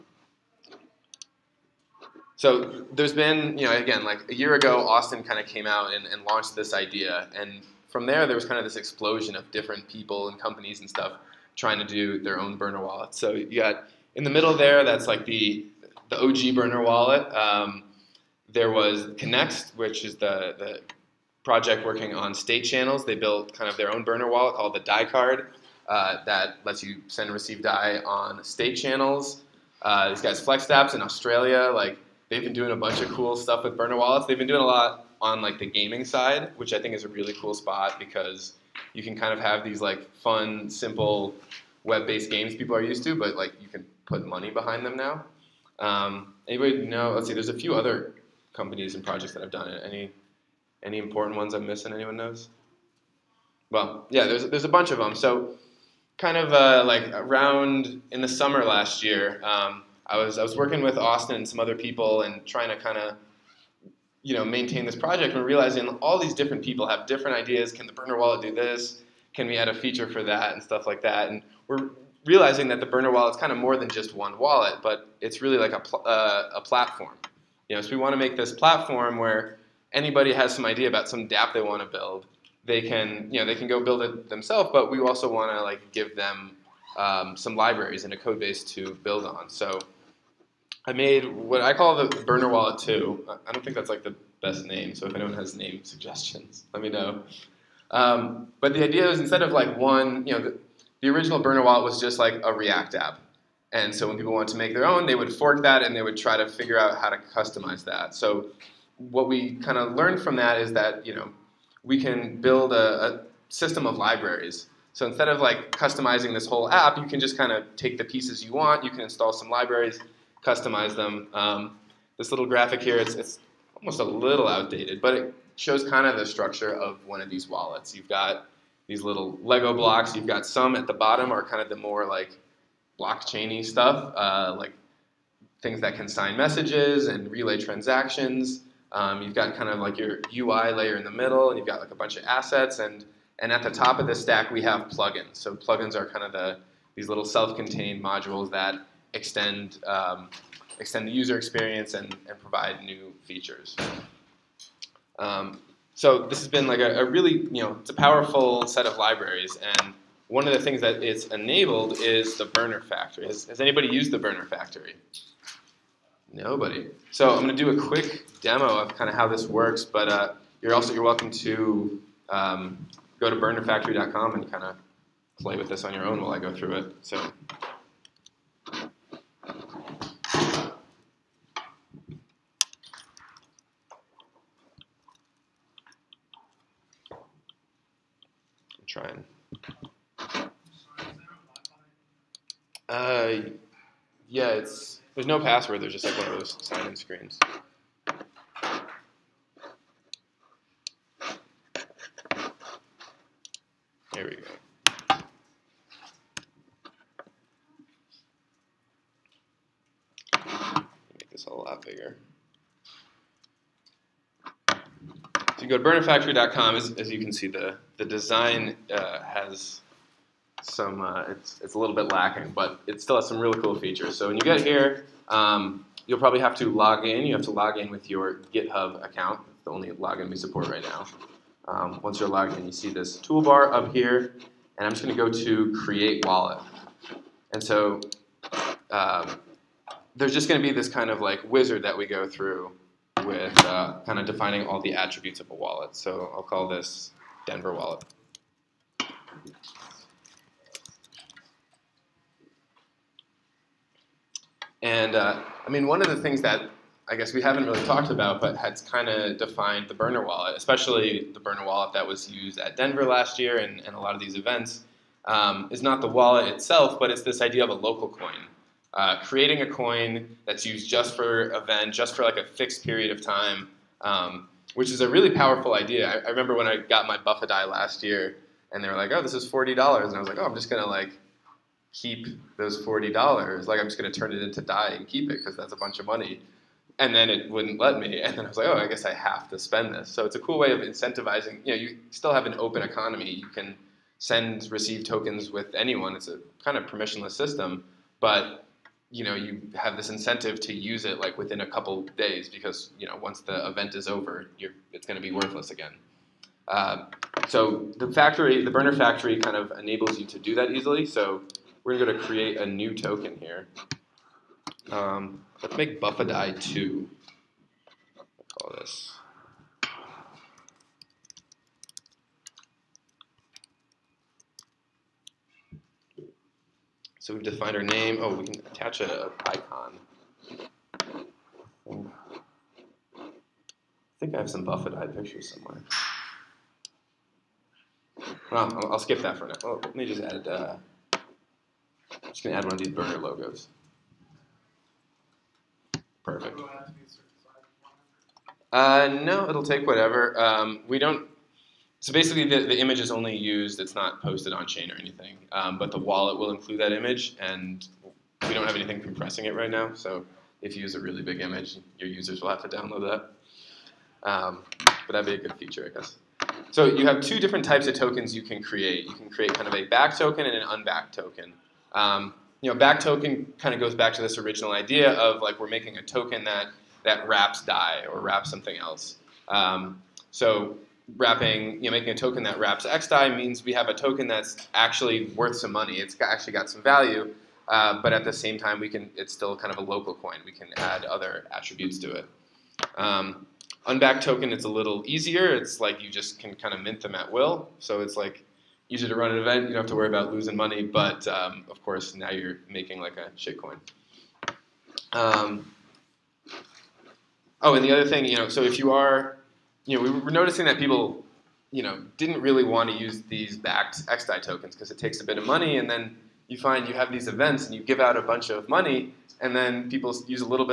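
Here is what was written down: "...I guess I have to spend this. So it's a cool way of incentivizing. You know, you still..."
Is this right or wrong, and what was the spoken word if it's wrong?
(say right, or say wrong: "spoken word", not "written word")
right.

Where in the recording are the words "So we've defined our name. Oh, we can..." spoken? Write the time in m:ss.
5:27.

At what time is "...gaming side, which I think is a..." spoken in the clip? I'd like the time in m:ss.
0:35.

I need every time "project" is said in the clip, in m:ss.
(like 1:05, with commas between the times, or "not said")
0:21, 0:49, 1:04.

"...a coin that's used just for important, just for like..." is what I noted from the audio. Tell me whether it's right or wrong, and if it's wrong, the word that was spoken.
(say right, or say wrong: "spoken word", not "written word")
wrong: "event", not "important".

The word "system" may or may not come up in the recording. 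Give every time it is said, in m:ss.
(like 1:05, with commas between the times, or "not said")
1:53, 4:57.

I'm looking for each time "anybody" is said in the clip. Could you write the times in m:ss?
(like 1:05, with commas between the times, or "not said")
0:46, 1:19, 2:43.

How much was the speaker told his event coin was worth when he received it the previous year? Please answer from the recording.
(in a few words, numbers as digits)
$40.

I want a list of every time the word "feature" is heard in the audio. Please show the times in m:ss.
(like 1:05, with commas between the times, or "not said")
1:09, 2:33, 3:43, 6:05.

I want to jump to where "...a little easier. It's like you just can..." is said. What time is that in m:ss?
6:34.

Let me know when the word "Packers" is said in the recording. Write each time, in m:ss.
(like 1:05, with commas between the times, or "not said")
not said.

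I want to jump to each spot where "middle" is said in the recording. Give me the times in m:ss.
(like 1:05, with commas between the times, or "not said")
0:14, 2:21.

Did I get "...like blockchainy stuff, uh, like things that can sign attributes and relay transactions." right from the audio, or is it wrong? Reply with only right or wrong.
wrong.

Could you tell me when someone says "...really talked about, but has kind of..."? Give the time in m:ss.
4:17.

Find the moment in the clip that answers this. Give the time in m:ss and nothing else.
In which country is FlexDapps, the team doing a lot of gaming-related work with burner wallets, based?
0:31.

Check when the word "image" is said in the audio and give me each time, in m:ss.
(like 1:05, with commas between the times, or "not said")
5:52, 5:56, 6:01.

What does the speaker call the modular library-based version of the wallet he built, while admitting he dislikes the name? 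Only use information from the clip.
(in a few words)
burner wallet 2.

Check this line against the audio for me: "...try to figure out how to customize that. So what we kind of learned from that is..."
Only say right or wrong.
right.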